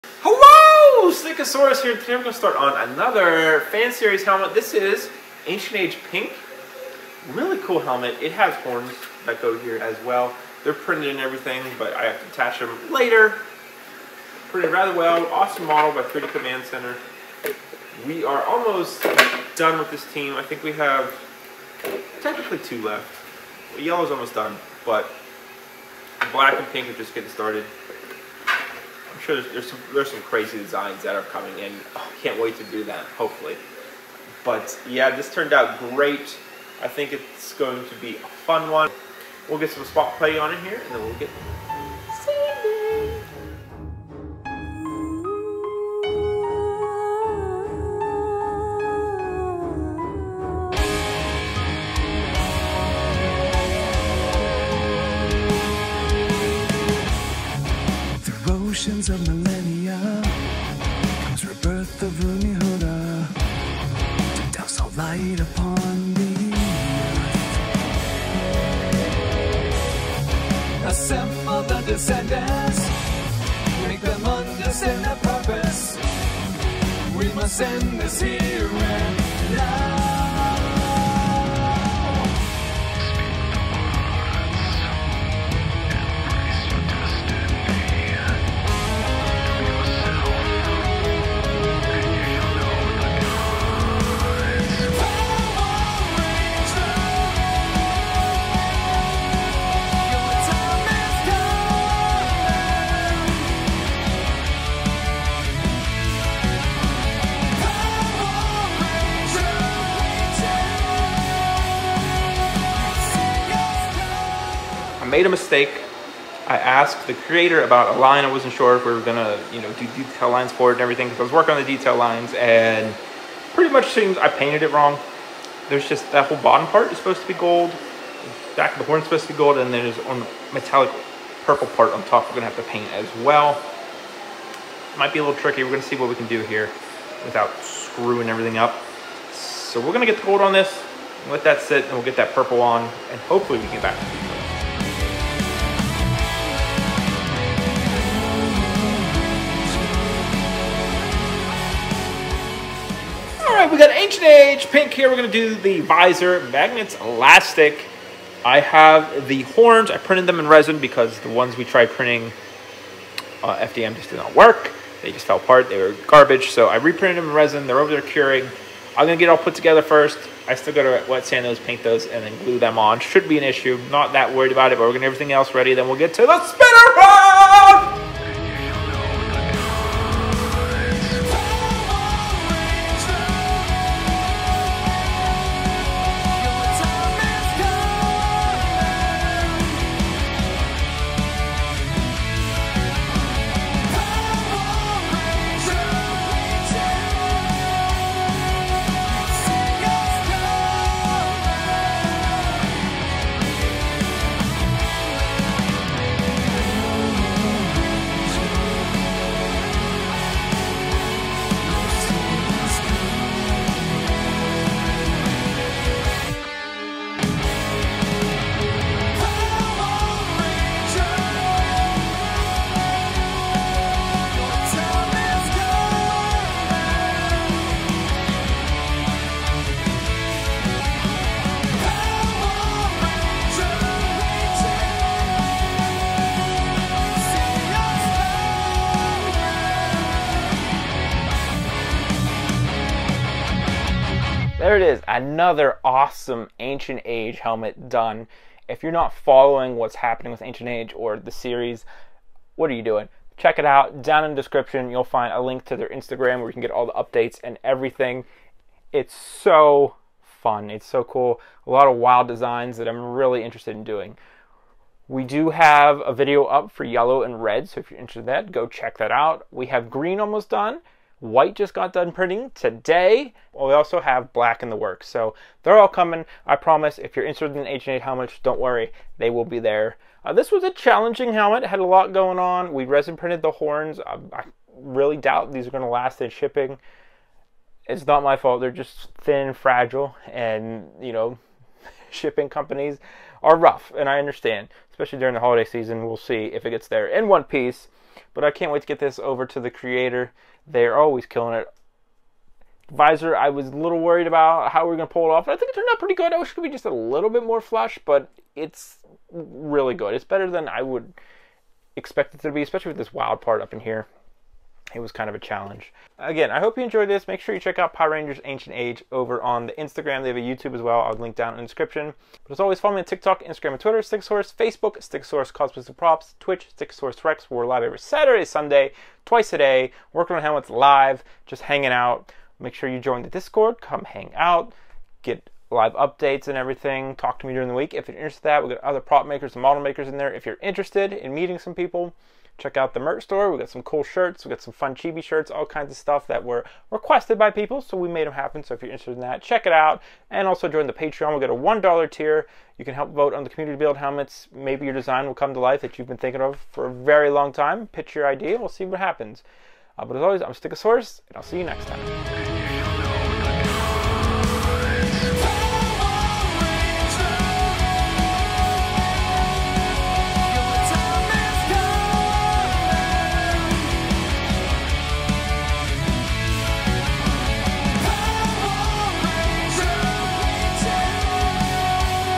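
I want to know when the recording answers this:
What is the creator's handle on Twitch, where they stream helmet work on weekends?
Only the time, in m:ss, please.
5:26.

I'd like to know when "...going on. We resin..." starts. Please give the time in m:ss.
4:42.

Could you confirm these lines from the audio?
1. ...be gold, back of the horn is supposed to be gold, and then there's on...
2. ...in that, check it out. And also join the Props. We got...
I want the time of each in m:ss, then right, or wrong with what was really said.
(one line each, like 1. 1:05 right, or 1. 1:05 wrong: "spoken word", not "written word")
1. 2:07 right
2. 5:49 wrong: "Patreon", not "Props".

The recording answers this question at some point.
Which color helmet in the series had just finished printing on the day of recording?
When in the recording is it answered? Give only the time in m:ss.
4:31.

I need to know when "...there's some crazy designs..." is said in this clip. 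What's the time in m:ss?
0:29.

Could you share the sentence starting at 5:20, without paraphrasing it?
They have a YouTube as well.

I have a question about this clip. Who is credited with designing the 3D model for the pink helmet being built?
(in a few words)
3D Command Center.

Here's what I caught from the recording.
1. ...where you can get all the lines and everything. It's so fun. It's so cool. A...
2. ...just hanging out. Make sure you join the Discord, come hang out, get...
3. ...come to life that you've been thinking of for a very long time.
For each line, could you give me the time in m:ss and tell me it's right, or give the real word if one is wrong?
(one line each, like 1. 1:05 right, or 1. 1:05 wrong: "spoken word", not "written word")
1. 4:16 wrong: "updates", not "lines"
2. 5:31 right
3. 5:55 right.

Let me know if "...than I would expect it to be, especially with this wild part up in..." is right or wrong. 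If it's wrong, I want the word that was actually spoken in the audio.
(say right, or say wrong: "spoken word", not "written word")
right.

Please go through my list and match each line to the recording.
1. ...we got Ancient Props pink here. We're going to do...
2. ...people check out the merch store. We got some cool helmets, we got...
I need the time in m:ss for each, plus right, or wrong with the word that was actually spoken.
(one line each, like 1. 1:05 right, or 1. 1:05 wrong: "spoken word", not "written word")
1. 2:33 wrong: "Age", not "Props"
2. 5:41 wrong: "shirts", not "helmets".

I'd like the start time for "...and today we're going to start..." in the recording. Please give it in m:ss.
0:01.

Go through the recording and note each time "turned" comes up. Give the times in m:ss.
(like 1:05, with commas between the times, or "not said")
0:35, 5:05.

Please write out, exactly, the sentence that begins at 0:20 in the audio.
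I think we have technically two left.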